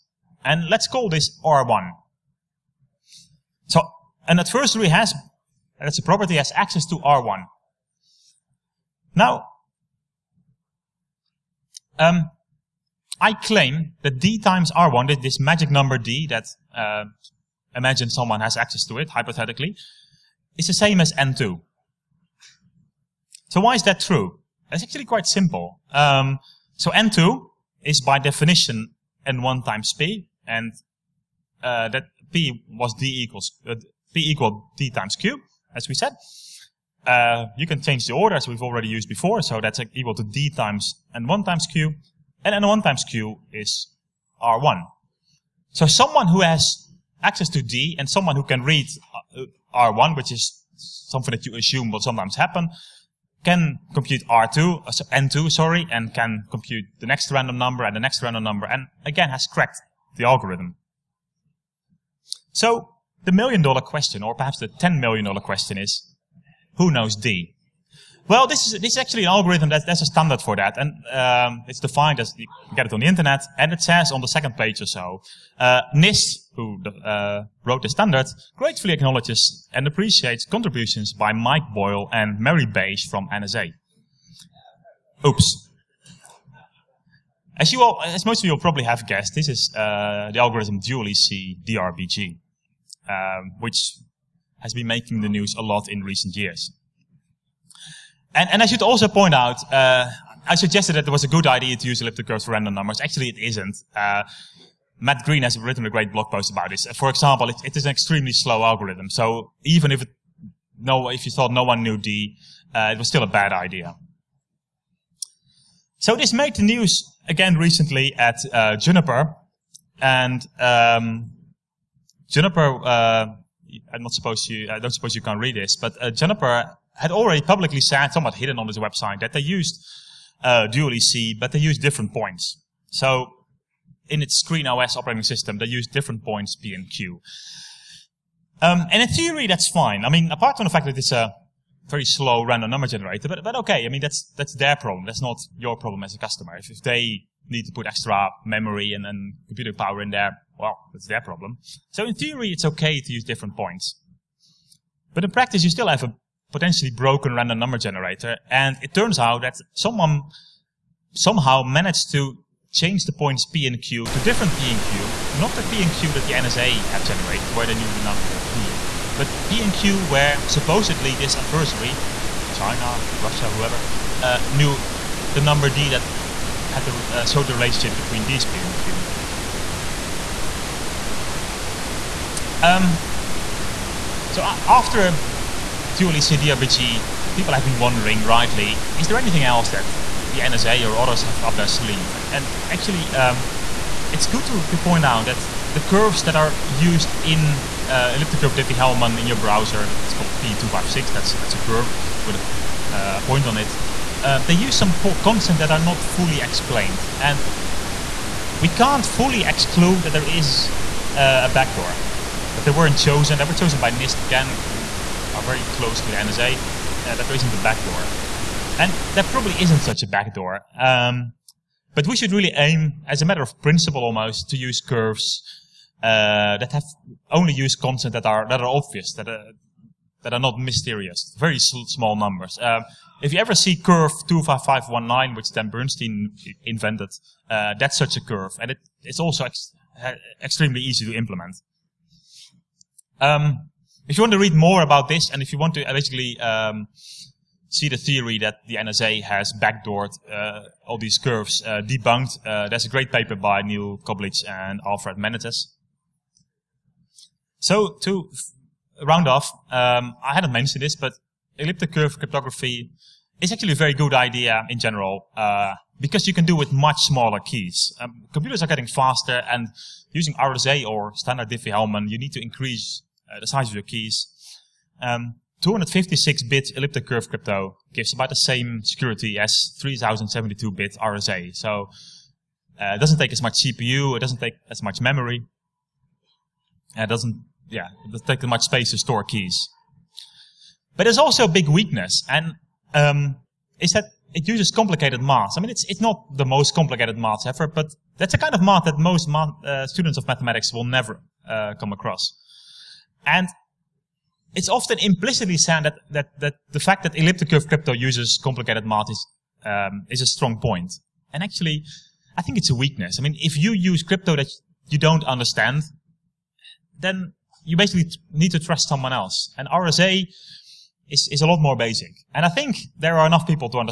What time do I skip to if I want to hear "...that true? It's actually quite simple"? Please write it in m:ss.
0:23.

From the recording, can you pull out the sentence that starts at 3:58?
And it, it's also ex extremely easy to implement.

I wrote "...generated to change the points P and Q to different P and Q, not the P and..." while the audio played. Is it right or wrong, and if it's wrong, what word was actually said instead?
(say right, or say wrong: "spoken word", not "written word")
wrong: "managed", not "generated".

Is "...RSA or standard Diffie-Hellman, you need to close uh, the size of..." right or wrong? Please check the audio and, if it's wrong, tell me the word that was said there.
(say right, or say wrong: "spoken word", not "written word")
wrong: "increase", not "close".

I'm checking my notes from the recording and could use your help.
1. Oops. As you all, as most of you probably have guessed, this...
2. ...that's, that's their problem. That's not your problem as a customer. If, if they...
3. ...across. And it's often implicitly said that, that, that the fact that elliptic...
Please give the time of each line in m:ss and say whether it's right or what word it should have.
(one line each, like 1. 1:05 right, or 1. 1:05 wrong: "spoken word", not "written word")
1. 1:25 right
2. 2:24 right
3. 5:01 right.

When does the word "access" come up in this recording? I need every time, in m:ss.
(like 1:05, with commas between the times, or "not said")
0:06, 0:18, 0:47.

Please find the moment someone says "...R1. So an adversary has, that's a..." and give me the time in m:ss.
0:01.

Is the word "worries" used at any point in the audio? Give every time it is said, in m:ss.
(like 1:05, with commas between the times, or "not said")
not said.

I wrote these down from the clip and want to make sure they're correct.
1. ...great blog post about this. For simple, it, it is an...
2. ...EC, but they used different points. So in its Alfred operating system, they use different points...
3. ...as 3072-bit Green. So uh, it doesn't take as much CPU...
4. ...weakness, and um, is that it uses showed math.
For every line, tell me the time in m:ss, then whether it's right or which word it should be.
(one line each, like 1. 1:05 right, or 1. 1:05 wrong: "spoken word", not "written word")
1. 1:45 wrong: "example", not "simple"
2. 2:10 wrong: "ScreenOS", not "Alfred"
3. 4:39 wrong: "RSA", not "Green"
4. 4:51 wrong: "complicated", not "showed".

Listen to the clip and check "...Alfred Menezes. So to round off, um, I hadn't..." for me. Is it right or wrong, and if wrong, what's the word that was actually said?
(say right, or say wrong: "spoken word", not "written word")
right.